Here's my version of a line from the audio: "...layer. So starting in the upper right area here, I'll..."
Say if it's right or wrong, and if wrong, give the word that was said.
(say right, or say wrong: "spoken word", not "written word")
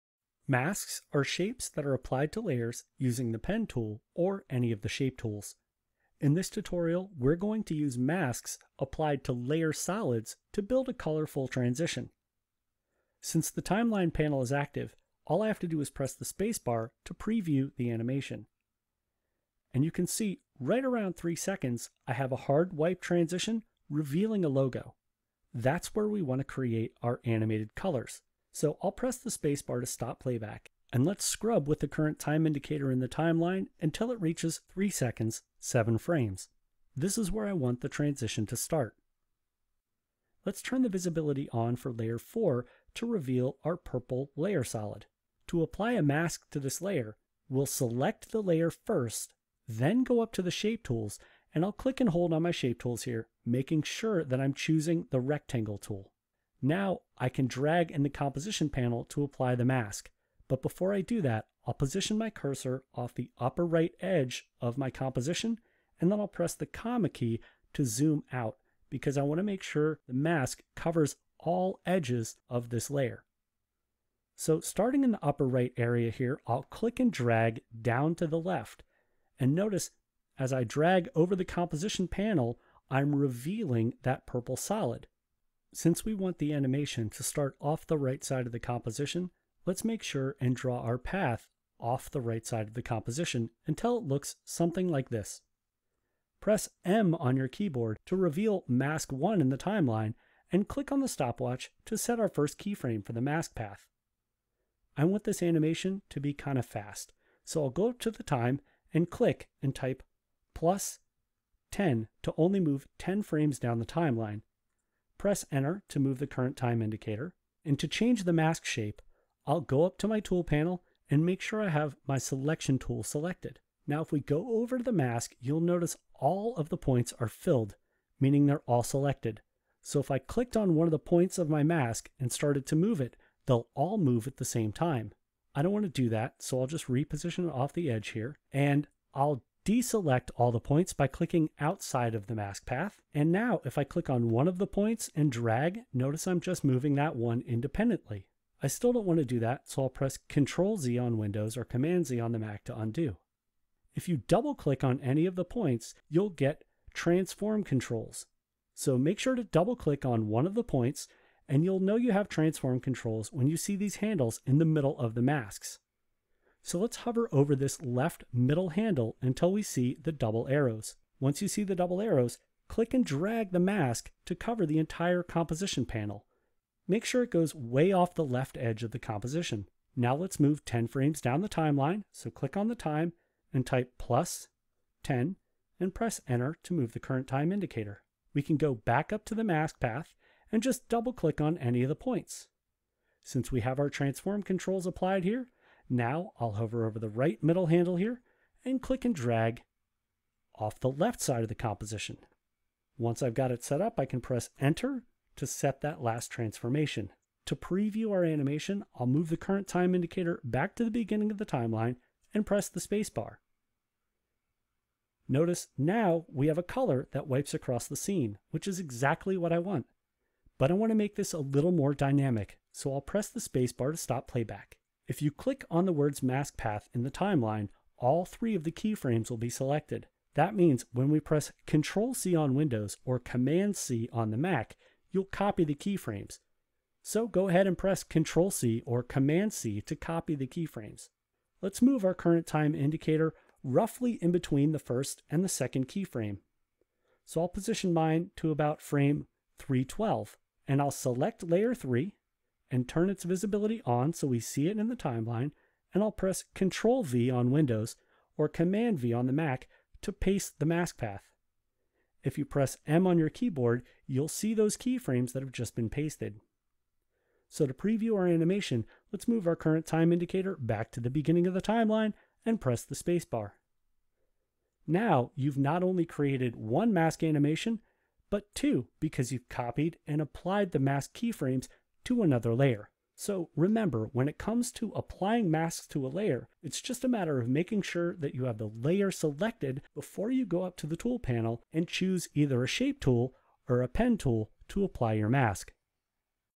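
right.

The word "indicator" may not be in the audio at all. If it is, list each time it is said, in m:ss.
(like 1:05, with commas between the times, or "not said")
0:32, 1:56, 3:07, 3:29, 4:02, 4:30.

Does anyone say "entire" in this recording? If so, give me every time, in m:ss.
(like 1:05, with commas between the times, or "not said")
2:54.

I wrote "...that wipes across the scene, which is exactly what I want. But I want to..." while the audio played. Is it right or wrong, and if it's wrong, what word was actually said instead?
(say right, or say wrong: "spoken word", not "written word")
right.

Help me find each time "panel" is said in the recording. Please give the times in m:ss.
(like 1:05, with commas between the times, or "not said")
0:14, 0:58, 1:22, 2:00, 2:55, 4:51.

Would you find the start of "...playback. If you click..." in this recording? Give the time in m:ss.
3:44.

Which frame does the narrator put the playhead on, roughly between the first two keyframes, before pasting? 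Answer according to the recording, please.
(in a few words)
312.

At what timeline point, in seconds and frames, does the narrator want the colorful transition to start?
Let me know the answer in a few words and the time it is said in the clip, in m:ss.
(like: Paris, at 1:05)
3 seconds, 7 frames, at 0:34.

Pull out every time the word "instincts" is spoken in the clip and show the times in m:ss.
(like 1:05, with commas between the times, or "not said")
not said.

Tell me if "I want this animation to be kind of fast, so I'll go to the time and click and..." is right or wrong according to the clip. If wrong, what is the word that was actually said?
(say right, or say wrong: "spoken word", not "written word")
right.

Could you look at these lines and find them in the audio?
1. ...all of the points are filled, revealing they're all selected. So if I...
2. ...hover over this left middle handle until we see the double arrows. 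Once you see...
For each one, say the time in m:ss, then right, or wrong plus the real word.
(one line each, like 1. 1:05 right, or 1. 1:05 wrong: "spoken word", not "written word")
1. 2:06 wrong: "meaning", not "revealing"
2. 2:46 right.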